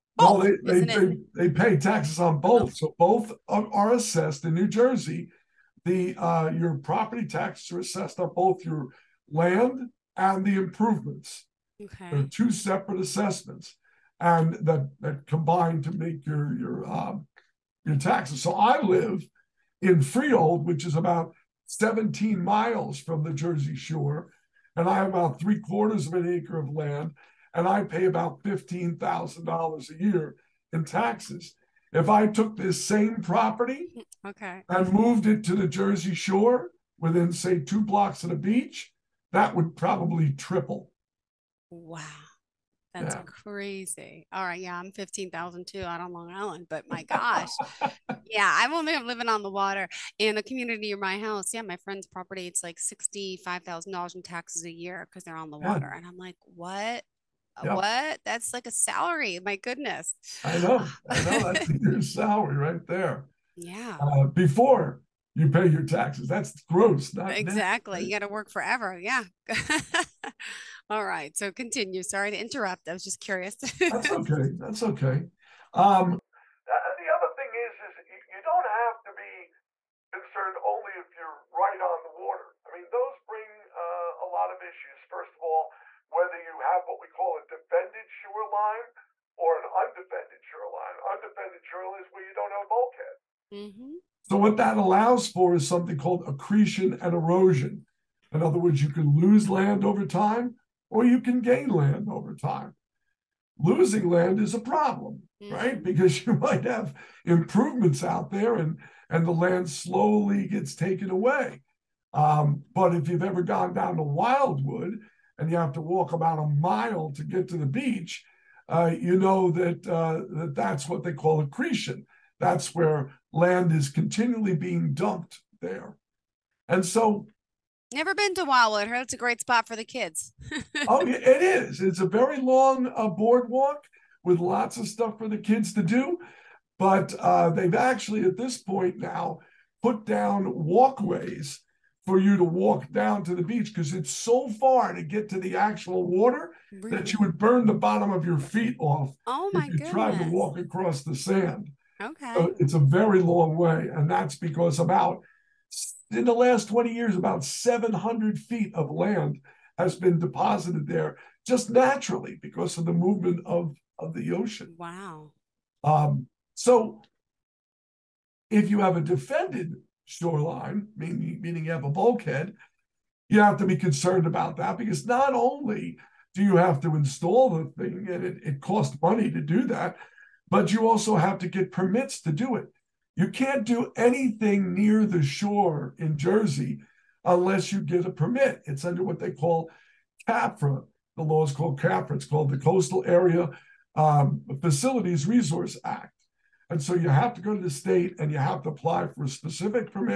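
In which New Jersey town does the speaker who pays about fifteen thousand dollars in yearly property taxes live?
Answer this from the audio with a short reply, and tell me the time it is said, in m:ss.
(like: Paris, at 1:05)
Freehold, at 0:20.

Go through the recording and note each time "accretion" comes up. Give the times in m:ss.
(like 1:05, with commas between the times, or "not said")
1:36, 2:01.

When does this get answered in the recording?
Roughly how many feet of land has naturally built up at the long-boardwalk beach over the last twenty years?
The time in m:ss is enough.
2:37.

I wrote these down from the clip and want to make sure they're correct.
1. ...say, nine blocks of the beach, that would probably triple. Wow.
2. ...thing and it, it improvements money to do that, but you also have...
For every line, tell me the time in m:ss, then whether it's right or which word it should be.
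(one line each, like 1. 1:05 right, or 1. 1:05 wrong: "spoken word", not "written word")
1. 0:37 wrong: "two", not "nine"
2. 2:57 wrong: "costs", not "improvements".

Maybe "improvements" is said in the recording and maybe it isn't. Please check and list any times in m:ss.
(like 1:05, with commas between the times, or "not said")
0:10, 1:47.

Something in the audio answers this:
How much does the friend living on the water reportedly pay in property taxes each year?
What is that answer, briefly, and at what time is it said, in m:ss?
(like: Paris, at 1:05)
$65,000, at 0:52.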